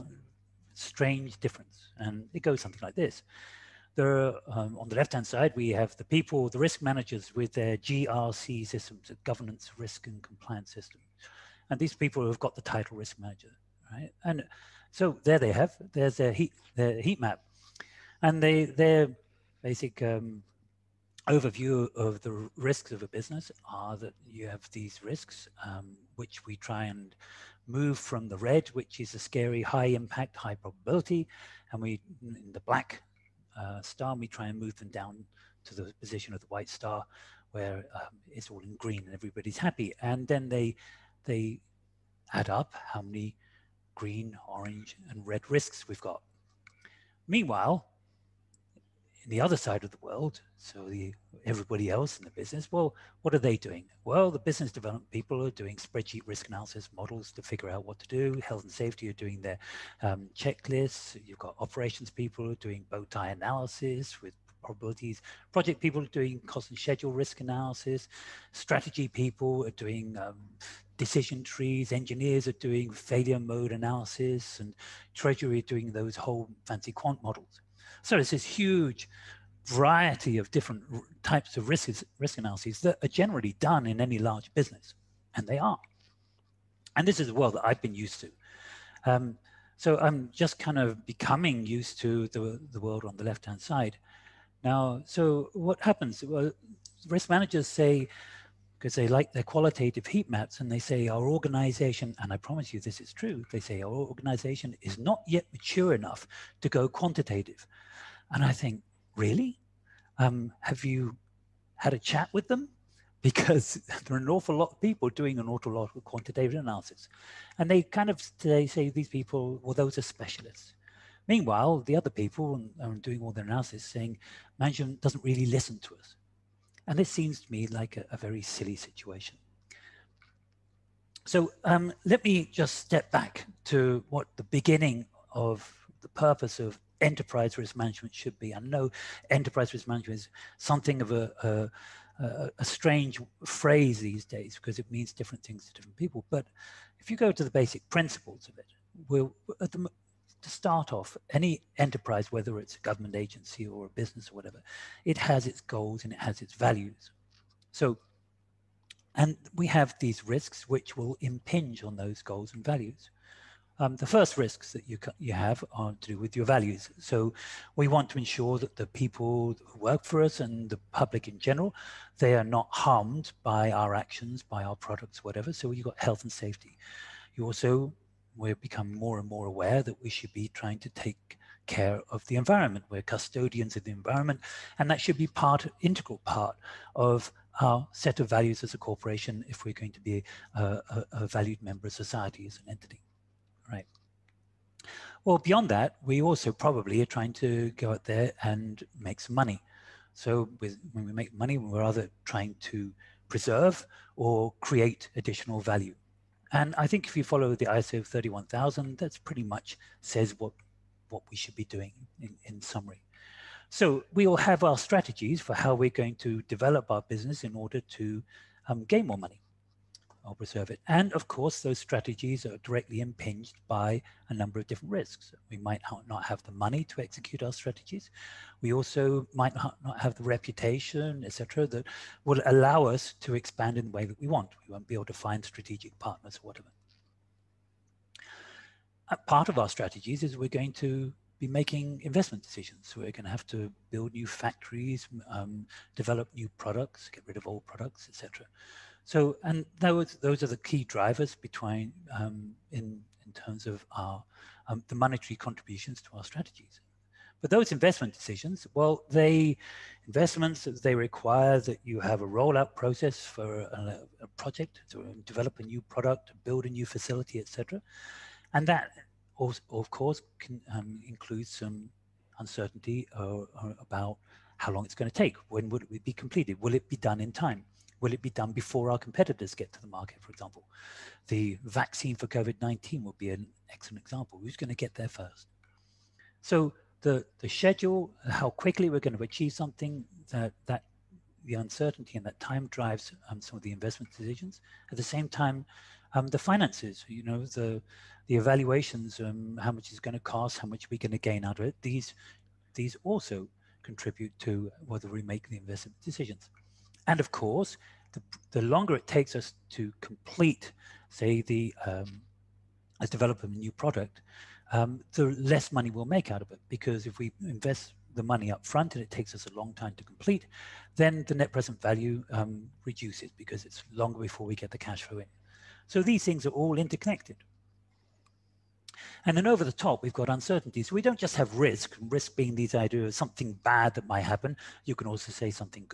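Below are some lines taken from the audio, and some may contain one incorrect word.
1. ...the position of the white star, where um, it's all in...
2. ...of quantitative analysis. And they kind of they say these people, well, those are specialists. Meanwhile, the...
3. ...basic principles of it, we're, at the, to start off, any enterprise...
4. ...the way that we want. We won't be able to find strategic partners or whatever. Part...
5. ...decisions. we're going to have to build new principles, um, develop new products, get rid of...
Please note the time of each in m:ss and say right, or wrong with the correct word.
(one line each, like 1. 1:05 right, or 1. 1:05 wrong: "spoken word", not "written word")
1. 0:35 right
2. 1:55 right
3. 2:27 right
4. 3:53 right
5. 4:02 wrong: "factories", not "principles".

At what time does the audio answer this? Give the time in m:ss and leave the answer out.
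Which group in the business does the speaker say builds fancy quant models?
1:15.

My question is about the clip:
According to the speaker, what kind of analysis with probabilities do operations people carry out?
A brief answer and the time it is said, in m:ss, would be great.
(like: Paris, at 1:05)
Bow tie analysis, at 1:02.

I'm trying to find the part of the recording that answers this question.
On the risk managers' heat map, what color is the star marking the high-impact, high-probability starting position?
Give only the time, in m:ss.
0:32.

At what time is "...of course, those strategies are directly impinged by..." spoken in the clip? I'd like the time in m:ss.
3:41.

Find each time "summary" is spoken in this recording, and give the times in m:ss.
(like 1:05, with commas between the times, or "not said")
3:32.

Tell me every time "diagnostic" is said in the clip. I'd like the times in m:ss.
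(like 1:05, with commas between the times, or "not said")
not said.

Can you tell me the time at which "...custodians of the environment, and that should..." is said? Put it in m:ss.
3:03.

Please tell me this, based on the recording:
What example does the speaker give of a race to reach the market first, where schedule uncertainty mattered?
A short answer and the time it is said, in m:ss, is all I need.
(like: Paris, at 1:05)
The COVID-19 vaccine, at 4:41.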